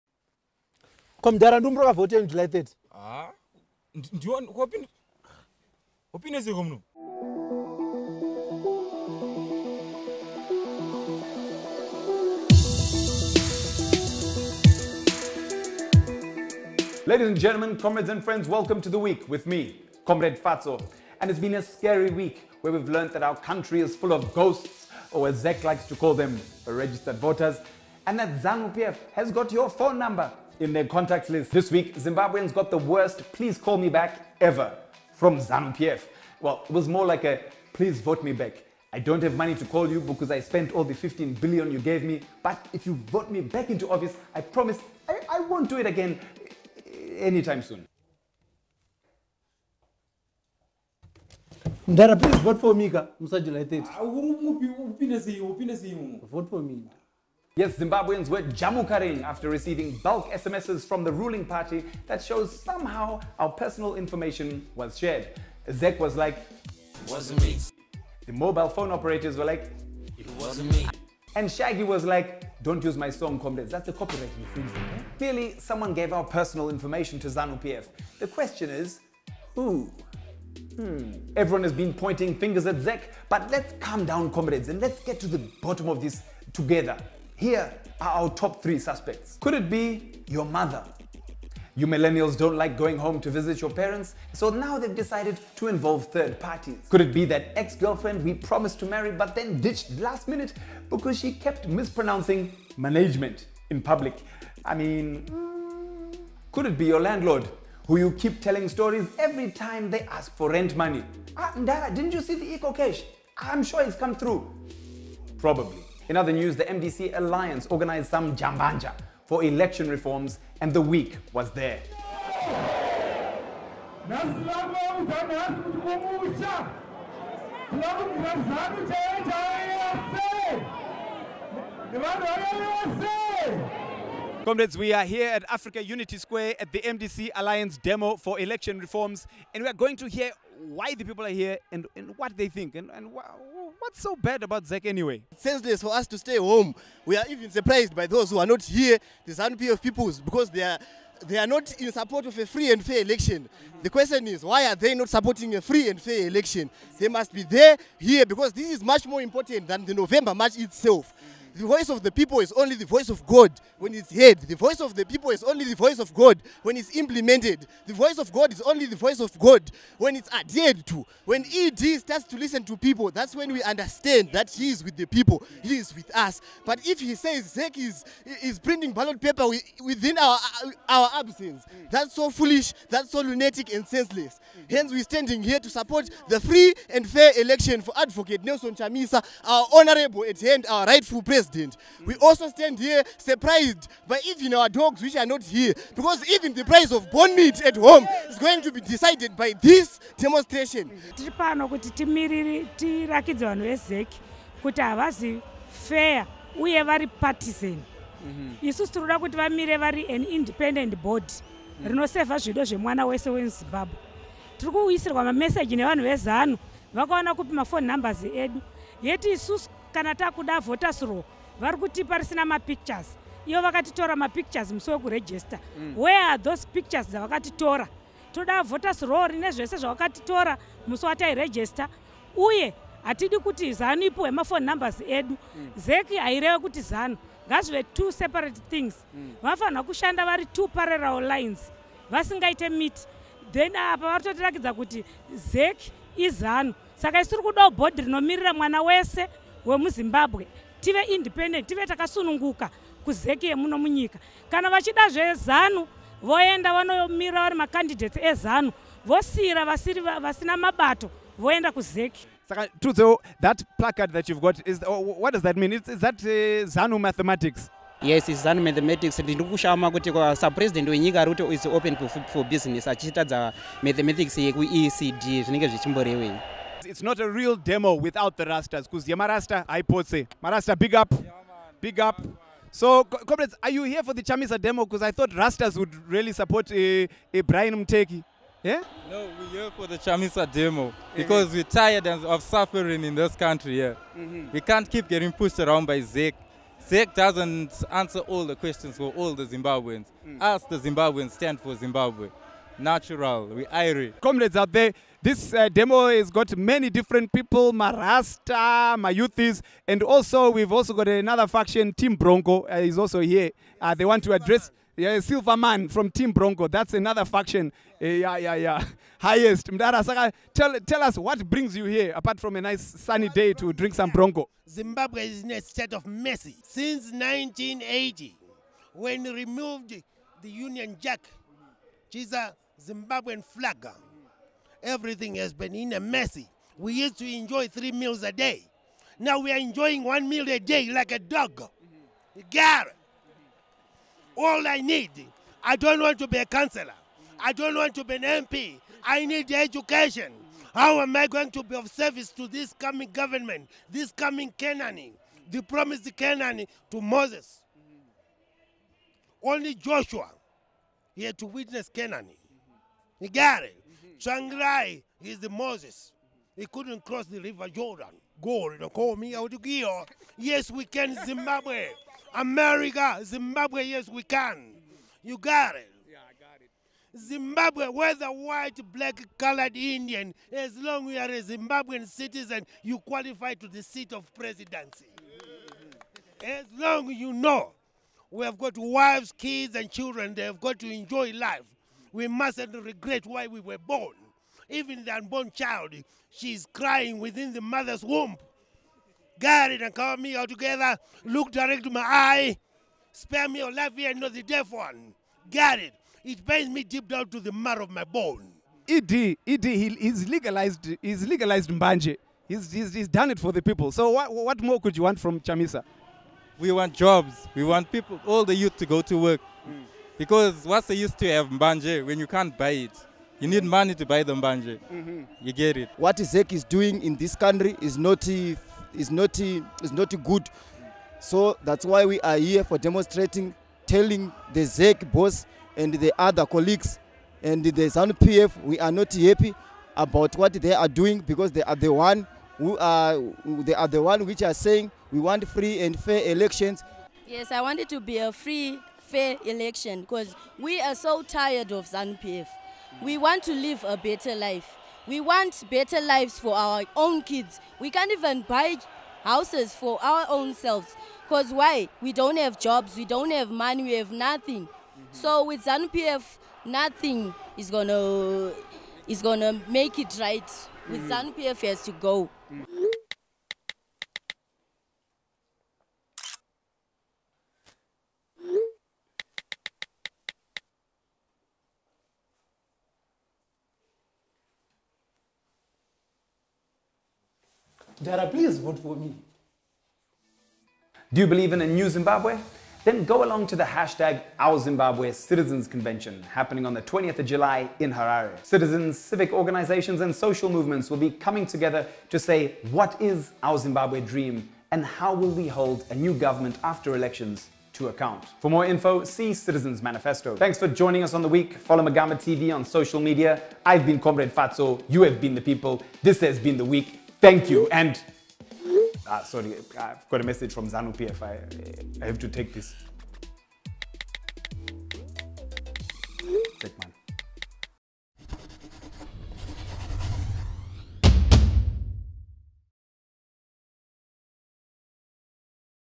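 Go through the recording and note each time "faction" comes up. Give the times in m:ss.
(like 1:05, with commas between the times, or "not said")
5:11, 5:17.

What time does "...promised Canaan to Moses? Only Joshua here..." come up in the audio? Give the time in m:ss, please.
5:55.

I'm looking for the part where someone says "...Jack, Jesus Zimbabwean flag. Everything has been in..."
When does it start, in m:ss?
5:30.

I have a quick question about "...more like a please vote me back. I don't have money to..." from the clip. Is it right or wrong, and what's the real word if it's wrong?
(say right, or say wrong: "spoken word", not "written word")
right.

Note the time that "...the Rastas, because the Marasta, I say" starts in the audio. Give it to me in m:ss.
4:38.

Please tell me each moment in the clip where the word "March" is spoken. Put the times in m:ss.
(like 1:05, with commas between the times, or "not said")
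2:40.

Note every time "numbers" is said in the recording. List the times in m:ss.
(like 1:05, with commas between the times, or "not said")
0:29, 3:37, 3:54.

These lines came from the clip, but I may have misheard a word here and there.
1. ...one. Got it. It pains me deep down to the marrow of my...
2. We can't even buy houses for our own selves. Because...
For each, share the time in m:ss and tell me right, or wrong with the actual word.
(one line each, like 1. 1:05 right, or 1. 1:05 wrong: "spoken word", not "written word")
1. 6:44 right
2. 7:37 right.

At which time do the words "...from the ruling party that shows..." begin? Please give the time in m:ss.
1:00.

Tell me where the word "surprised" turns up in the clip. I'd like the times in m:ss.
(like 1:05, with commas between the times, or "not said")
2:27, 3:13.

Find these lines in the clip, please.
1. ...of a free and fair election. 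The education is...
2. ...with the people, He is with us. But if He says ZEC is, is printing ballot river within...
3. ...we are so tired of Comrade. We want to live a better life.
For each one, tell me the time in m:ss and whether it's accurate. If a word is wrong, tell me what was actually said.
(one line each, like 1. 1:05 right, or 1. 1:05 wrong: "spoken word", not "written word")
1. 2:32 wrong: "question", not "education"
2. 2:54 wrong: "paper", not "river"
3. 7:30 wrong: "ZANPF", not "Comrade".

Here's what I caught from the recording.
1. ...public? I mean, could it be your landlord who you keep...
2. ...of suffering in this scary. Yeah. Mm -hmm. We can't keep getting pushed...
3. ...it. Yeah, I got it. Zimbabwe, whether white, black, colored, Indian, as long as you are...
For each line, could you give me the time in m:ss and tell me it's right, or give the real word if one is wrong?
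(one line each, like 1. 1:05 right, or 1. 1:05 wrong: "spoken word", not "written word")
1. 1:43 right
2. 4:52 wrong: "country", not "scary"
3. 6:15 right.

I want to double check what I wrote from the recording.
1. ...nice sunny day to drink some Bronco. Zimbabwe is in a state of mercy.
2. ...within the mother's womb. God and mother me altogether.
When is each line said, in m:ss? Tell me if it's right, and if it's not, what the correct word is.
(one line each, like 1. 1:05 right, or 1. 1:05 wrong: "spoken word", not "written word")
1. 5:22 right
2. 6:37 wrong: "cover", not "mother".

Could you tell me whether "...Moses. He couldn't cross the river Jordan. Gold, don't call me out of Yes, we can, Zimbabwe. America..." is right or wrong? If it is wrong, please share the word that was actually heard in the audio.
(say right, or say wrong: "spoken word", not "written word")
right.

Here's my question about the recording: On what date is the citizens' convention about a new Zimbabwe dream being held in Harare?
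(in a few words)
20 July.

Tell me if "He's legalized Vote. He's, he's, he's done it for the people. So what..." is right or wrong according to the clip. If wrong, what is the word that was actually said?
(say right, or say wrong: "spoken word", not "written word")
wrong: "Mbanje", not "Vote".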